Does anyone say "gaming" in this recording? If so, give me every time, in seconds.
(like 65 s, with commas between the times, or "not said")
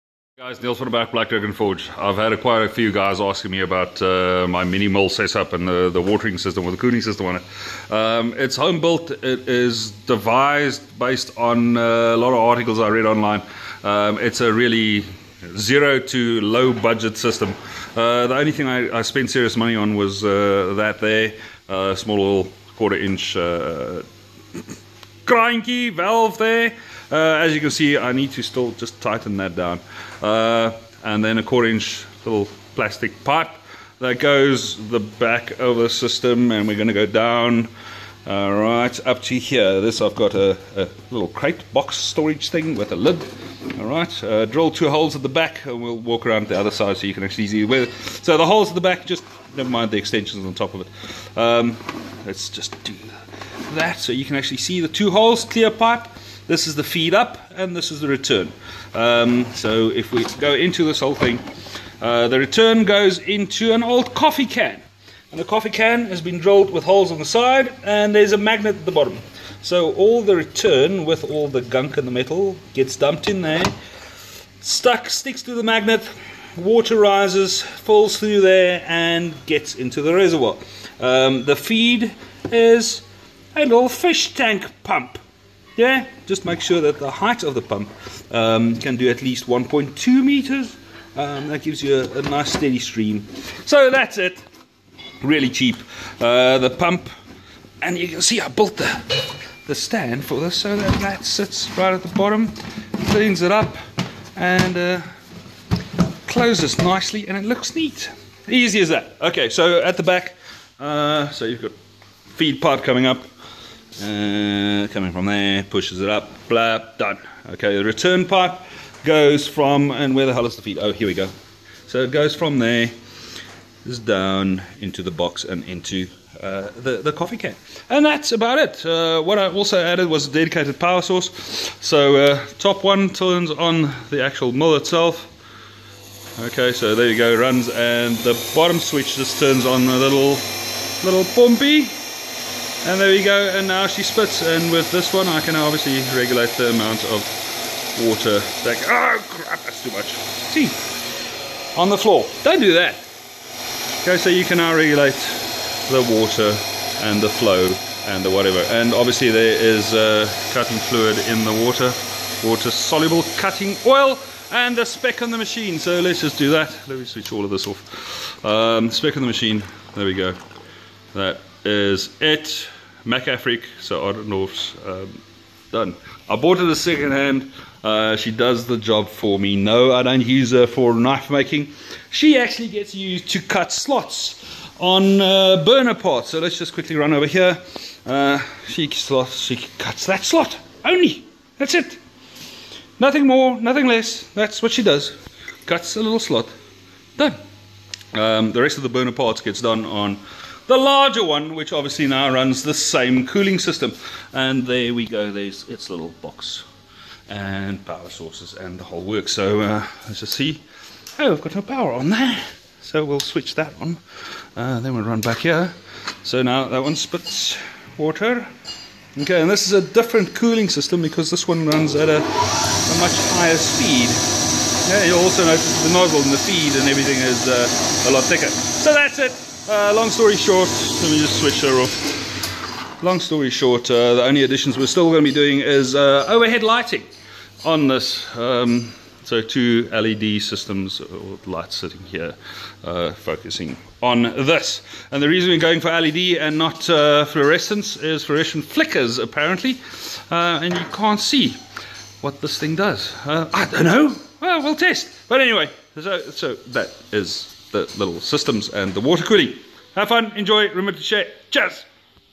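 not said.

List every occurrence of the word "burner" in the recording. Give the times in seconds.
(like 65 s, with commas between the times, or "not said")
185 s, 198 s.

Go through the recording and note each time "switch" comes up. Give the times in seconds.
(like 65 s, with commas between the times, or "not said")
138 s, 167 s, 213 s, 231 s.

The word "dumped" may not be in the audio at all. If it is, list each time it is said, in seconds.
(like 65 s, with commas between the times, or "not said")
72 s.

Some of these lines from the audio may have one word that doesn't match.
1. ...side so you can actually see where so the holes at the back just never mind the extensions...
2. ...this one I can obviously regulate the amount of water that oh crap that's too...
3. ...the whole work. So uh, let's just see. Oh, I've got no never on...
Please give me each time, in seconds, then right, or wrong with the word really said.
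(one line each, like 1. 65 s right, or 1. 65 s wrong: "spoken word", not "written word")
1. 46 s right
2. 144 s right
3. 208 s wrong: "power", not "never".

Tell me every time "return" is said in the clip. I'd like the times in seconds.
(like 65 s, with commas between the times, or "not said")
58 s, 62 s, 70 s, 117 s.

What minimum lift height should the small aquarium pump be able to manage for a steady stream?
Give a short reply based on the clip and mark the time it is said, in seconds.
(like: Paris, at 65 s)
1.2 meters, at 89 s.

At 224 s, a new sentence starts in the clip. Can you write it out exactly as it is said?
Yeah, you also notice the nozzle and the feed and everything is uh, a lot thicker.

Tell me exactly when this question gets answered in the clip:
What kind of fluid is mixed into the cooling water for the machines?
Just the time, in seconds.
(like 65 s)
162 s.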